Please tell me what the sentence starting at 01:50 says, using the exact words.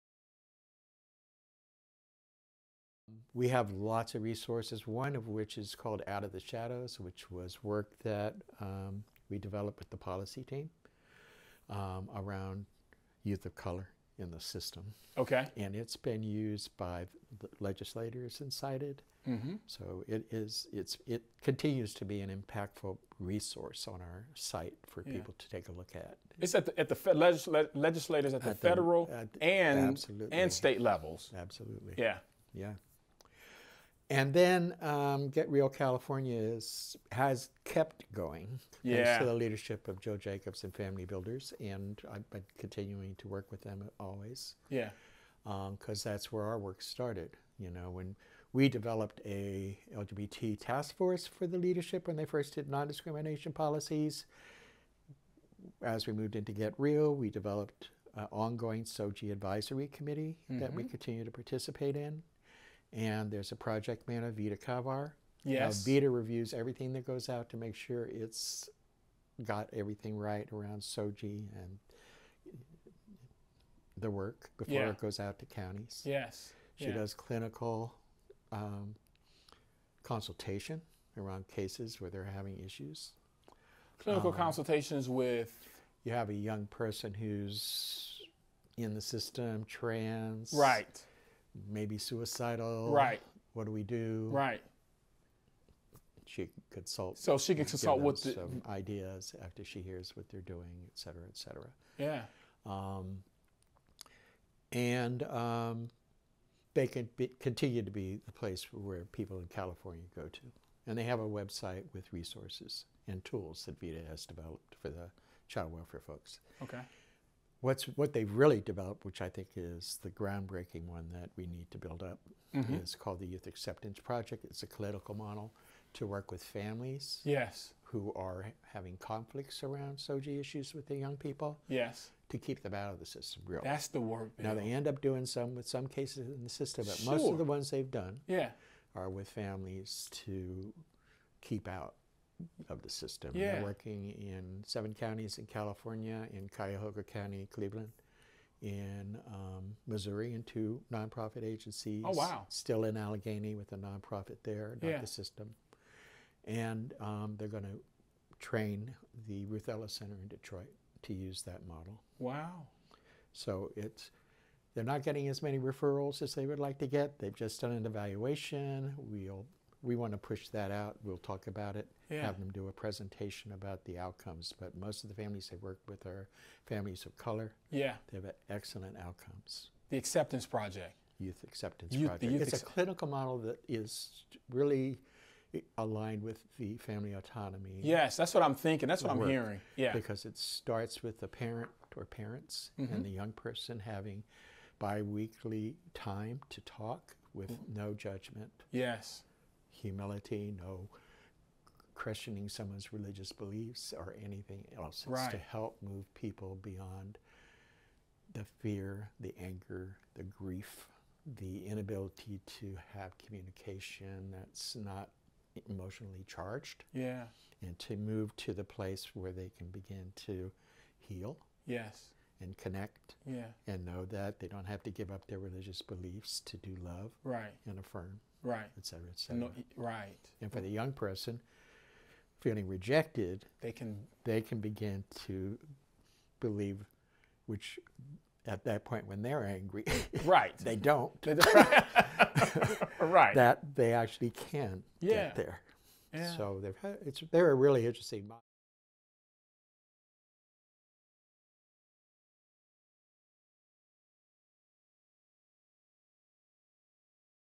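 And they have a website with resources and tools that Vida has developed for the child welfare folks.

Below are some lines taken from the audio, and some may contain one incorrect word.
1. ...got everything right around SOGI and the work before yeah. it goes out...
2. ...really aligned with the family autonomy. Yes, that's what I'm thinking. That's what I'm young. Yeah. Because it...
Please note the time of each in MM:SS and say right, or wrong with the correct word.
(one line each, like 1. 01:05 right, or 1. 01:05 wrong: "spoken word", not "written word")
1. 01:09 right
2. 03:04 wrong: "hearing", not "young".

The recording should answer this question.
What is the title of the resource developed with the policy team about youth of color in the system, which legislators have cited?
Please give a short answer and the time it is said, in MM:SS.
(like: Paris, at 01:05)
Out of the Shadows, at 00:06.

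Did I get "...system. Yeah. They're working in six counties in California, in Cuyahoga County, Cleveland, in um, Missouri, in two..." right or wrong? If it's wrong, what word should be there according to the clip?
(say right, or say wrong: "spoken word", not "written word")
wrong: "seven", not "six".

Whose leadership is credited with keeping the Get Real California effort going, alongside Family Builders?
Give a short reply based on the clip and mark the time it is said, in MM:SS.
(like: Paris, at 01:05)
Joe Jacobs, at 00:40.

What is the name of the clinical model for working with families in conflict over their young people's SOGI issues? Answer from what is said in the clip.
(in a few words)
Youth Acceptance Project.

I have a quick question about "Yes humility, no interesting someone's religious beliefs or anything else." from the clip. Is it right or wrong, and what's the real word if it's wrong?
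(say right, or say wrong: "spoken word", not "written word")
wrong: "questioning", not "interesting".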